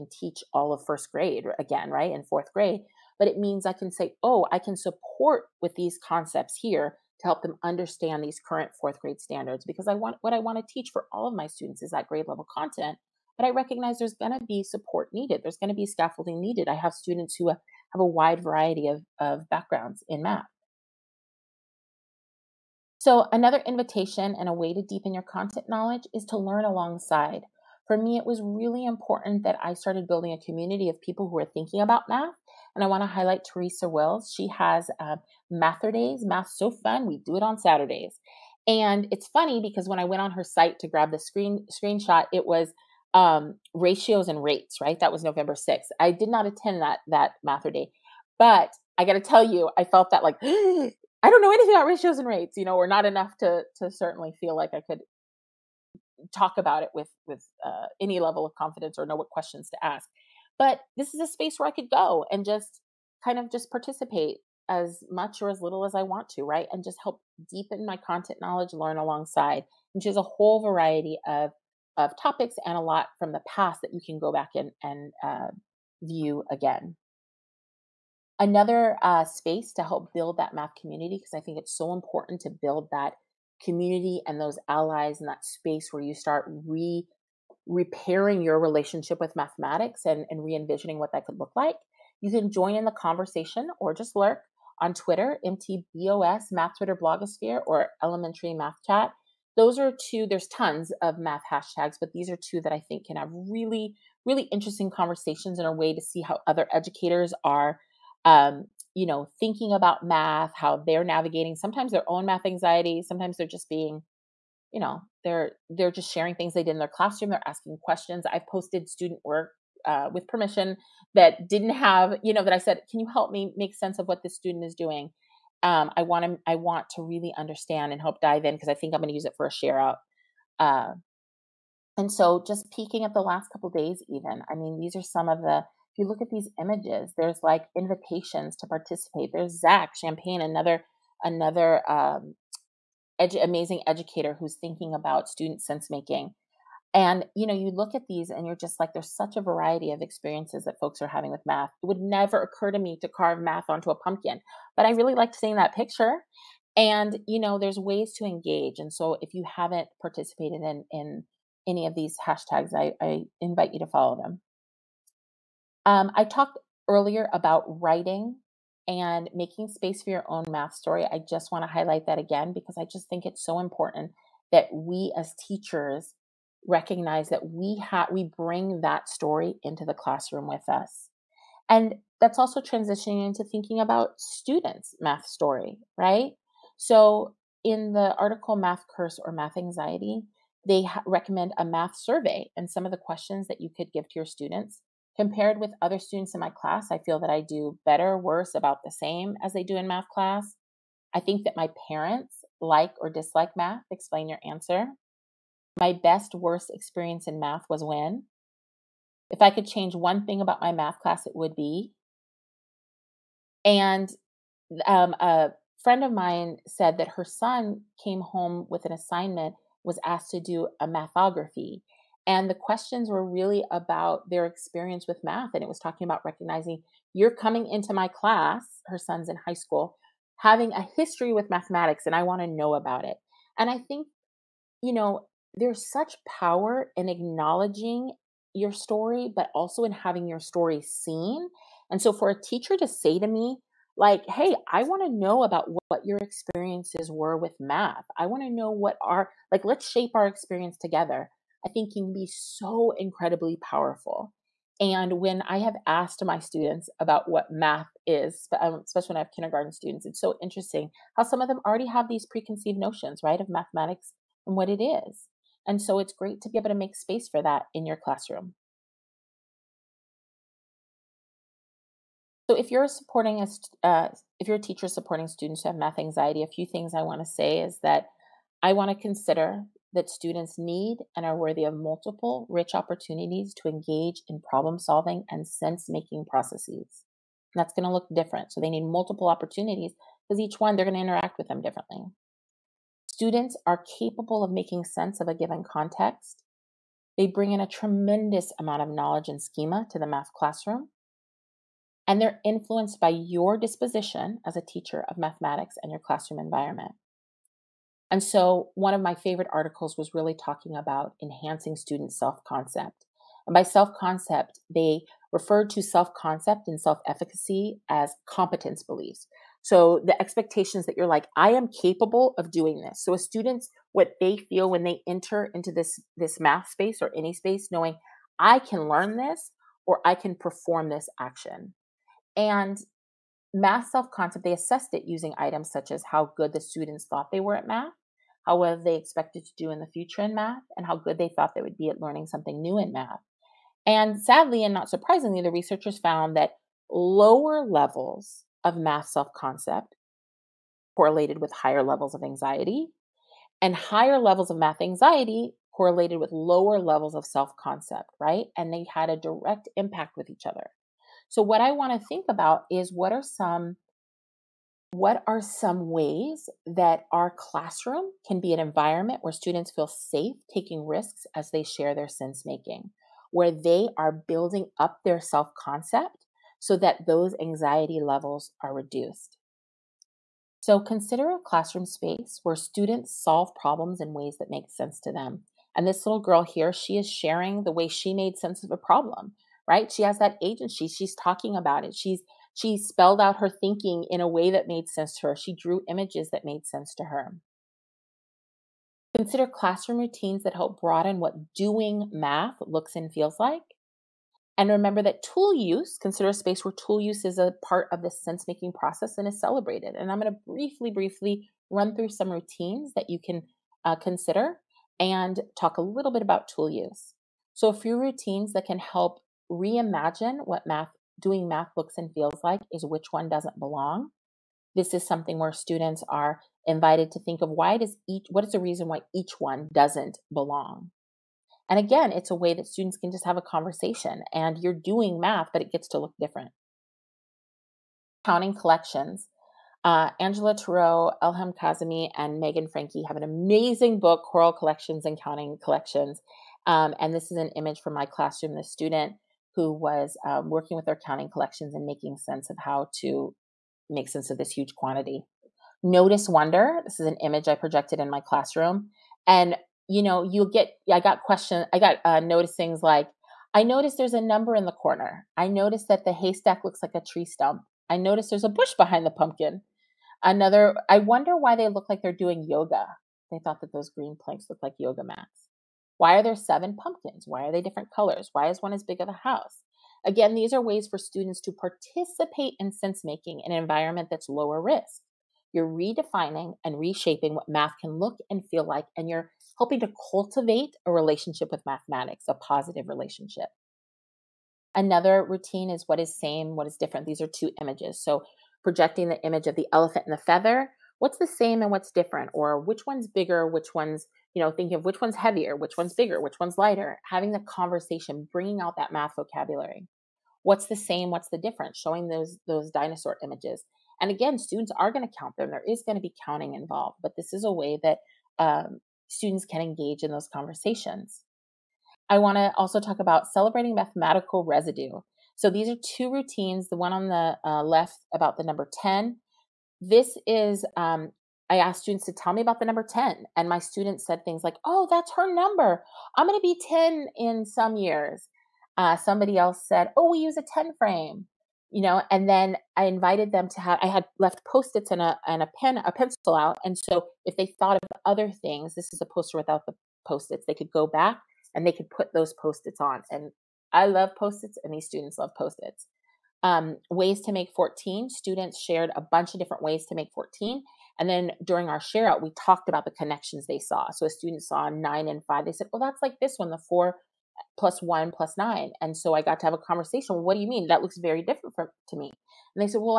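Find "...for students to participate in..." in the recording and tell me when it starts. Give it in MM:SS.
08:00.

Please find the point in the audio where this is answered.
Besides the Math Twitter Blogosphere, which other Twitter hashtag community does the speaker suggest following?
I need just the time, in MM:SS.
01:38.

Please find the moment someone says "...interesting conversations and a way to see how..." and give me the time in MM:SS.
01:44.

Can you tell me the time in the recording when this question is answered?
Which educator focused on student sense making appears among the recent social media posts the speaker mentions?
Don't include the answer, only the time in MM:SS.
02:19.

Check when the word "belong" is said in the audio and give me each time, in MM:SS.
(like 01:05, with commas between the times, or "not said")
07:03, 07:10.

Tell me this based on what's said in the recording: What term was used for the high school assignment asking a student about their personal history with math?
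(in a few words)
mathography.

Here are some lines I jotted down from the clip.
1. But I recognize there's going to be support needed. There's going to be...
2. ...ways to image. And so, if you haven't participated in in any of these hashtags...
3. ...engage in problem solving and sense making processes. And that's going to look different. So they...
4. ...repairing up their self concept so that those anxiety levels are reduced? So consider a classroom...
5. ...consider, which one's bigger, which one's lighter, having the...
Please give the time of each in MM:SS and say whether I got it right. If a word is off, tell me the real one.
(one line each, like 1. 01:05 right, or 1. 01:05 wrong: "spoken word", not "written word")
1. 00:13 right
2. 02:37 wrong: "engage", not "image"
3. 04:43 right
4. 06:14 wrong: "building", not "repairing"
5. 08:25 wrong: "heavier", not "consider".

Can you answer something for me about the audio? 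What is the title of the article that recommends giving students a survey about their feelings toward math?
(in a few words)
Math Curse or Math Anxiety.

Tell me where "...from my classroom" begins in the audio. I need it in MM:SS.
07:27.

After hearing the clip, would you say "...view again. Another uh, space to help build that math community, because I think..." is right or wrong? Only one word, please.
right.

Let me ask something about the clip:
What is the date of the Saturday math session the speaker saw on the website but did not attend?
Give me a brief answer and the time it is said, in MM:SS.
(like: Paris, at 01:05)
November 6th, at 00:45.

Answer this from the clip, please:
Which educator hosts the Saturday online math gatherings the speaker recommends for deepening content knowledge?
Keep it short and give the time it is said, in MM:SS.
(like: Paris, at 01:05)
Theresa Wills, at 00:33.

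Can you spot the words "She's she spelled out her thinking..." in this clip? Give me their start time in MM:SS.
06:31.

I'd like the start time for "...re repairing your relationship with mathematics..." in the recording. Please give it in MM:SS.
01:26.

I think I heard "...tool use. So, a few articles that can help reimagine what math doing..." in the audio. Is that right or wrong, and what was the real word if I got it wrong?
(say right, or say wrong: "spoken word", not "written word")
wrong: "routines", not "articles".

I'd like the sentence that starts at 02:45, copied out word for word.
Um, I talked earlier about writing and making space for your own math story.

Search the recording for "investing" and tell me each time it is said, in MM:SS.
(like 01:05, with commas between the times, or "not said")
not said.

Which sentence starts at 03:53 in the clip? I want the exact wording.
And I think, you know, there's such power in acknowledging your story, but also in having your story seen.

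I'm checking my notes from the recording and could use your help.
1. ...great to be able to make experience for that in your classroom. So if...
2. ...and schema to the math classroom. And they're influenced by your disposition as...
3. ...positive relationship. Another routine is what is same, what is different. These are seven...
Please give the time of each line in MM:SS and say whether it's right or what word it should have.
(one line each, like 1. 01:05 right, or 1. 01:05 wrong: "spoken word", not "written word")
1. 04:26 wrong: "space", not "experience"
2. 04:59 right
3. 08:12 wrong: "two", not "seven".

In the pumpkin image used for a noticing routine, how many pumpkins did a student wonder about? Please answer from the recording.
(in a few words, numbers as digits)
7.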